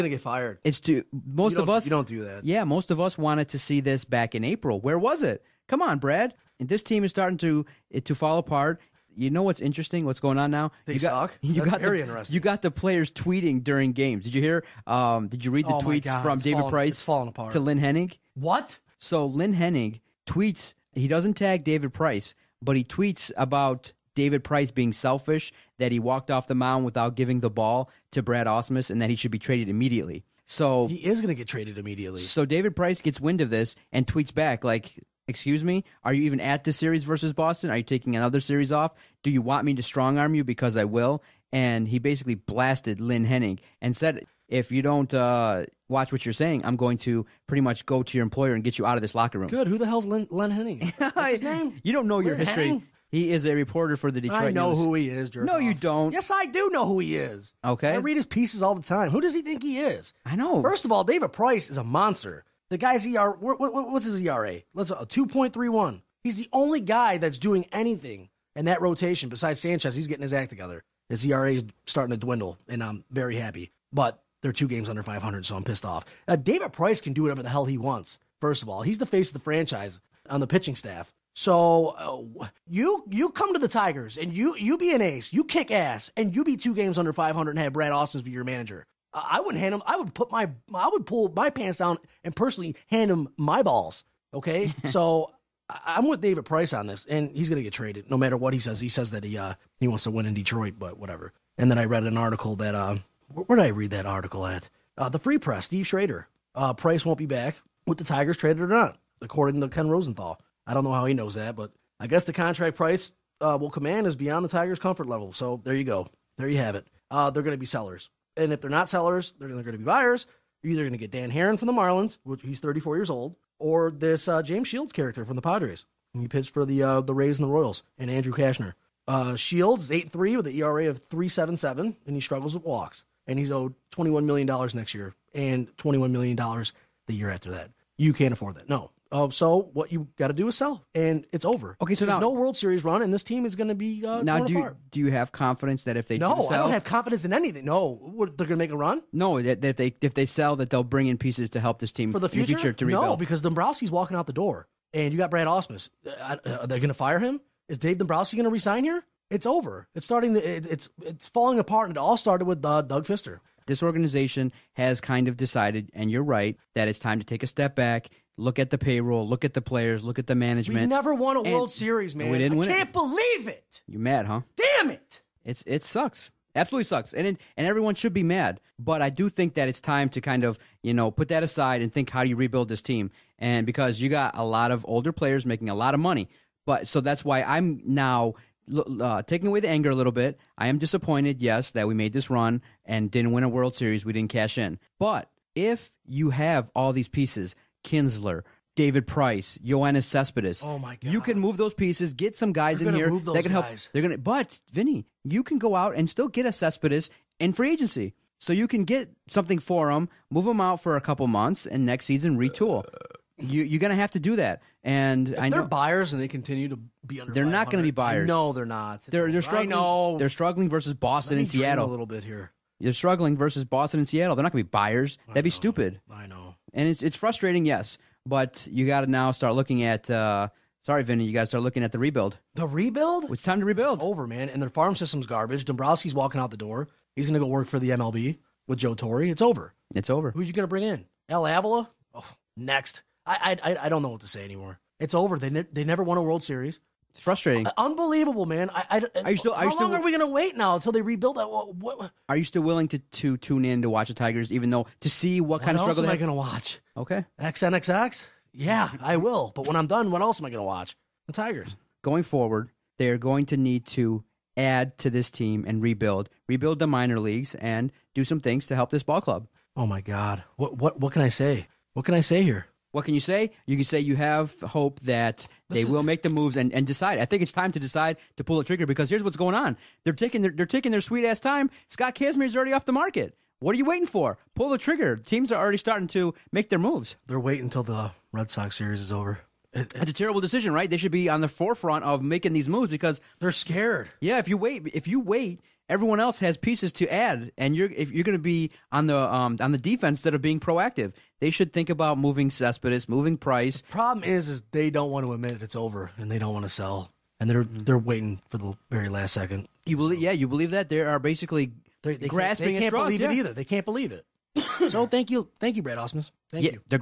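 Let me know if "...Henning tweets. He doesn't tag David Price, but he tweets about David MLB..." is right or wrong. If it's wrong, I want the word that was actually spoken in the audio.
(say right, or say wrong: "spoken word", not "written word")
wrong: "Price", not "MLB".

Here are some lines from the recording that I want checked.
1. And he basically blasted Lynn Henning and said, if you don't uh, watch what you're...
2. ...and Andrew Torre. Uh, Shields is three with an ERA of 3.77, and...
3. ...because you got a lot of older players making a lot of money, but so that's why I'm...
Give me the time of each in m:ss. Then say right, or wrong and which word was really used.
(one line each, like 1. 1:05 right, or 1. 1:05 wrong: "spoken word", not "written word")
1. 0:41 right
2. 2:07 wrong: "Cashner", not "Torre"
3. 3:03 right.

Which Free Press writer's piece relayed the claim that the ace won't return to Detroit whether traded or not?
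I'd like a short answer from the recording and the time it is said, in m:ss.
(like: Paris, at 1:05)
Steve Schrader, at 1:45.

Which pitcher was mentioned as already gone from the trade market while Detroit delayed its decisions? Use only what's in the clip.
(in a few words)
Scott Kazmir.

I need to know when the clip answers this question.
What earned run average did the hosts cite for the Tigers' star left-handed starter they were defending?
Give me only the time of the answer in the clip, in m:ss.
1:05.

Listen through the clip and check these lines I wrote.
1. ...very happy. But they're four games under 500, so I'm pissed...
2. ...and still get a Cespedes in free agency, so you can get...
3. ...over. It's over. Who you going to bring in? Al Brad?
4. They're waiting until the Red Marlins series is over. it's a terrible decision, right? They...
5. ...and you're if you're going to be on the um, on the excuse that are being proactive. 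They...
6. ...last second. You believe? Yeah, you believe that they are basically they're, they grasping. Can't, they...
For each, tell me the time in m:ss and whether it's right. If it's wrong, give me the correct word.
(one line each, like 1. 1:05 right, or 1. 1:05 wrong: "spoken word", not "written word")
1. 1:13 wrong: "two", not "four"
2. 3:25 right
3. 3:59 wrong: "Avila", not "Brad"
4. 4:47 wrong: "Sox", not "Marlins"
5. 4:57 wrong: "defense", not "excuse"
6. 5:09 right.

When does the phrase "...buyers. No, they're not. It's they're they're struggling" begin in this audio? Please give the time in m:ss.
3:37.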